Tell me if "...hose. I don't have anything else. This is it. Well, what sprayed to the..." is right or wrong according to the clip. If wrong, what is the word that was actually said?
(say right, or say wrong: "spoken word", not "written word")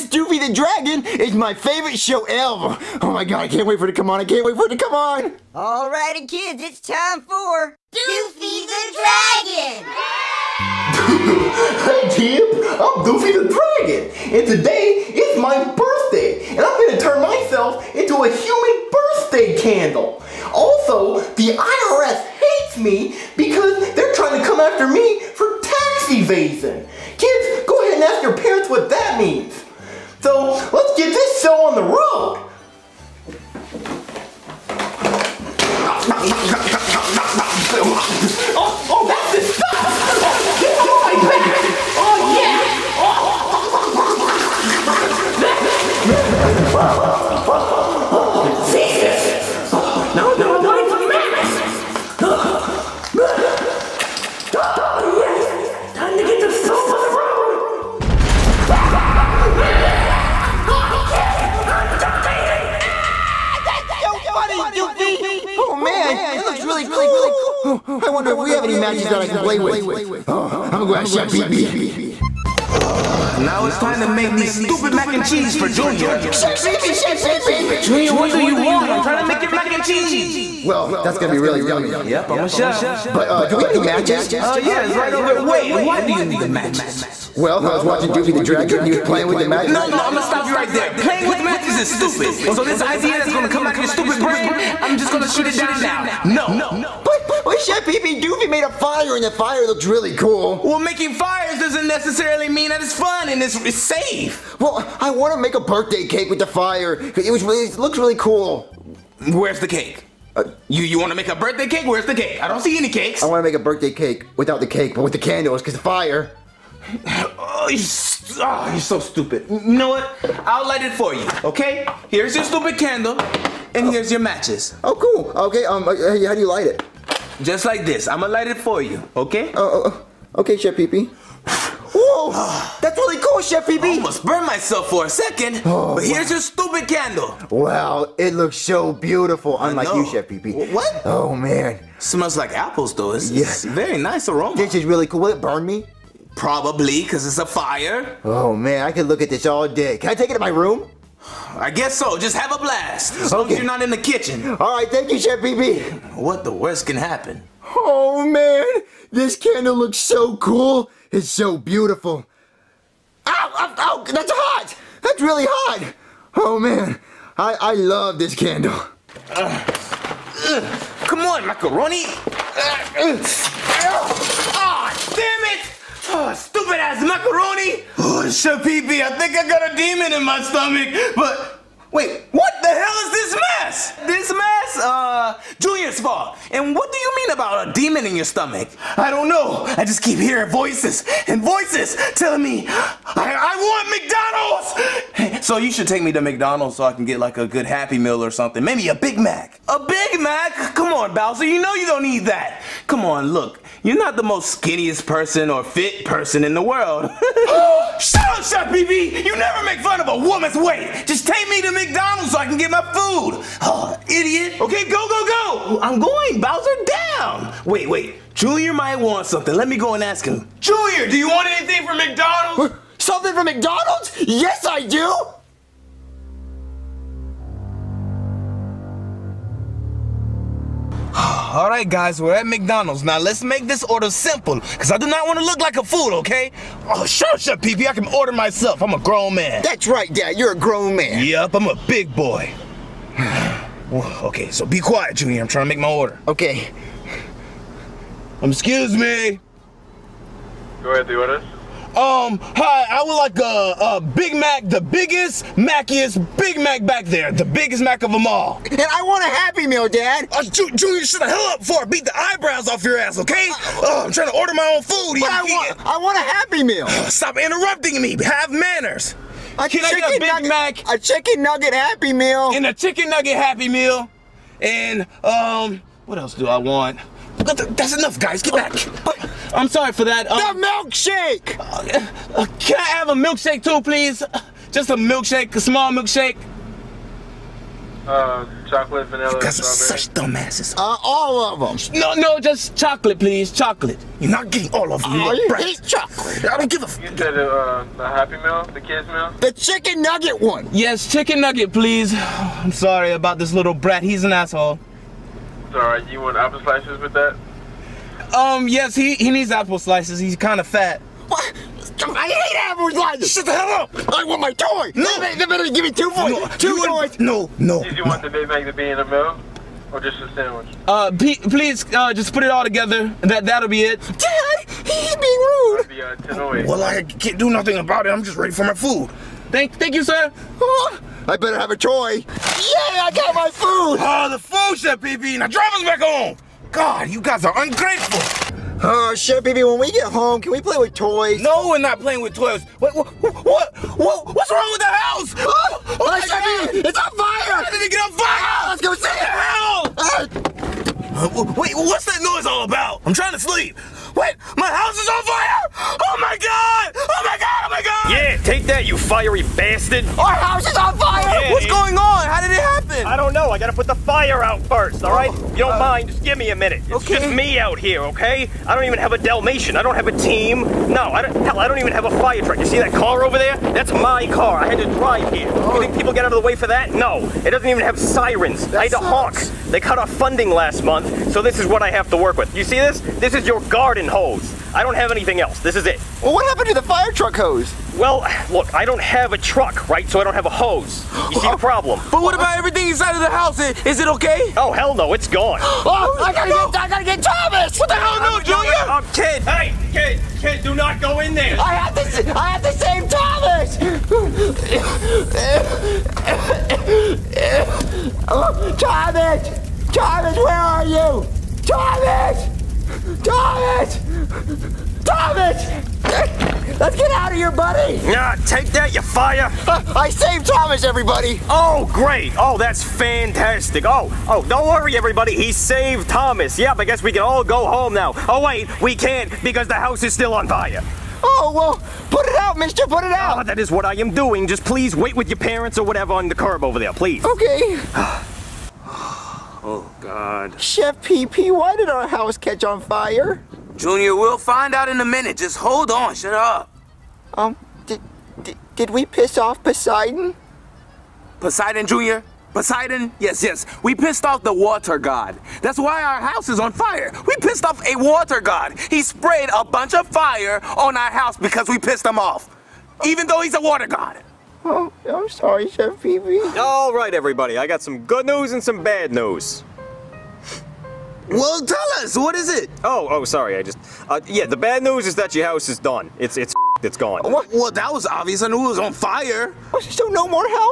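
wrong: "happened", not "sprayed".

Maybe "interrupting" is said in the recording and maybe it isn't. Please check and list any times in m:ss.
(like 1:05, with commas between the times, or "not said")
4:27.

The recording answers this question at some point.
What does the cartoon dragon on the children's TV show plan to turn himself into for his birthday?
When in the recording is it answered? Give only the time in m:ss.
0:18.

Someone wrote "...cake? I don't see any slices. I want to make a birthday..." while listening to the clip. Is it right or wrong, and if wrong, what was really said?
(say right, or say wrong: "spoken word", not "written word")
wrong: "cakes", not "slices".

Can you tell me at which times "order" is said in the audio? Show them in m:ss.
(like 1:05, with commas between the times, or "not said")
3:53, 3:58, 4:05, 4:11, 4:24.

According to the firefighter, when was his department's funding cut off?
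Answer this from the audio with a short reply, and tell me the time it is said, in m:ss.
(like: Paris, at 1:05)
last month, at 6:20.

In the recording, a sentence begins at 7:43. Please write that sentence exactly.
Even though he's a water god.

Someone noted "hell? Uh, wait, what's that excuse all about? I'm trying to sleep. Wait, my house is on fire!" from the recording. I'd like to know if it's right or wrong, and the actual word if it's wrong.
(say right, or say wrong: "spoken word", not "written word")
wrong: "noise", not "excuse".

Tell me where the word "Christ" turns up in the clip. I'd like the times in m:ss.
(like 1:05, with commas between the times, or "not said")
not said.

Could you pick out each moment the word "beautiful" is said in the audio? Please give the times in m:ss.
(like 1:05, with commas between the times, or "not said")
2:18, 2:41.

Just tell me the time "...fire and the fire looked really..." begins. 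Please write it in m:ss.
1:38.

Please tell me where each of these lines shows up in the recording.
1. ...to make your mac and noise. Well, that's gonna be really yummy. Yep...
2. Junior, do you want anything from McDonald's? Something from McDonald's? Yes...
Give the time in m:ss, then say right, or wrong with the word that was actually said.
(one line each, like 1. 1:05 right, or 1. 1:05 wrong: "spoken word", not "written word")
1. 1:19 wrong: "cheese", not "noise"
2. 3:40 right.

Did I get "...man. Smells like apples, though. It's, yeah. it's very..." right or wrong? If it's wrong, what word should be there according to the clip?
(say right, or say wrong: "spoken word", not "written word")
right.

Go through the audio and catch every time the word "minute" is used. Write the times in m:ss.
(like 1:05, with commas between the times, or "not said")
6:06, 7:25.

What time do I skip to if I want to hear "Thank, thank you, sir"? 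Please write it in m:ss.
5:29.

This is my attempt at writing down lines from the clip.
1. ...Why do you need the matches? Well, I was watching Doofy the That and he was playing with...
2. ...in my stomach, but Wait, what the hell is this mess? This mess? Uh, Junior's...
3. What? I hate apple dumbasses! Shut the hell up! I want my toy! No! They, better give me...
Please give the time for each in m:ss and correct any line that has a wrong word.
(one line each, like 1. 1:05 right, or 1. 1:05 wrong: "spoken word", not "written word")
1. 1:25 wrong: "Dragon", not "That"
2. 3:00 right
3. 5:11 wrong: "slices", not "dumbasses".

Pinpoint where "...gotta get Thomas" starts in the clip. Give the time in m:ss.
6:36.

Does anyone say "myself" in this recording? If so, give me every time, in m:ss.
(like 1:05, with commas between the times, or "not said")
0:17, 2:14, 3:58.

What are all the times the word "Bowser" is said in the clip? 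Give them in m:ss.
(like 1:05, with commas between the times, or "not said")
3:21, 3:36.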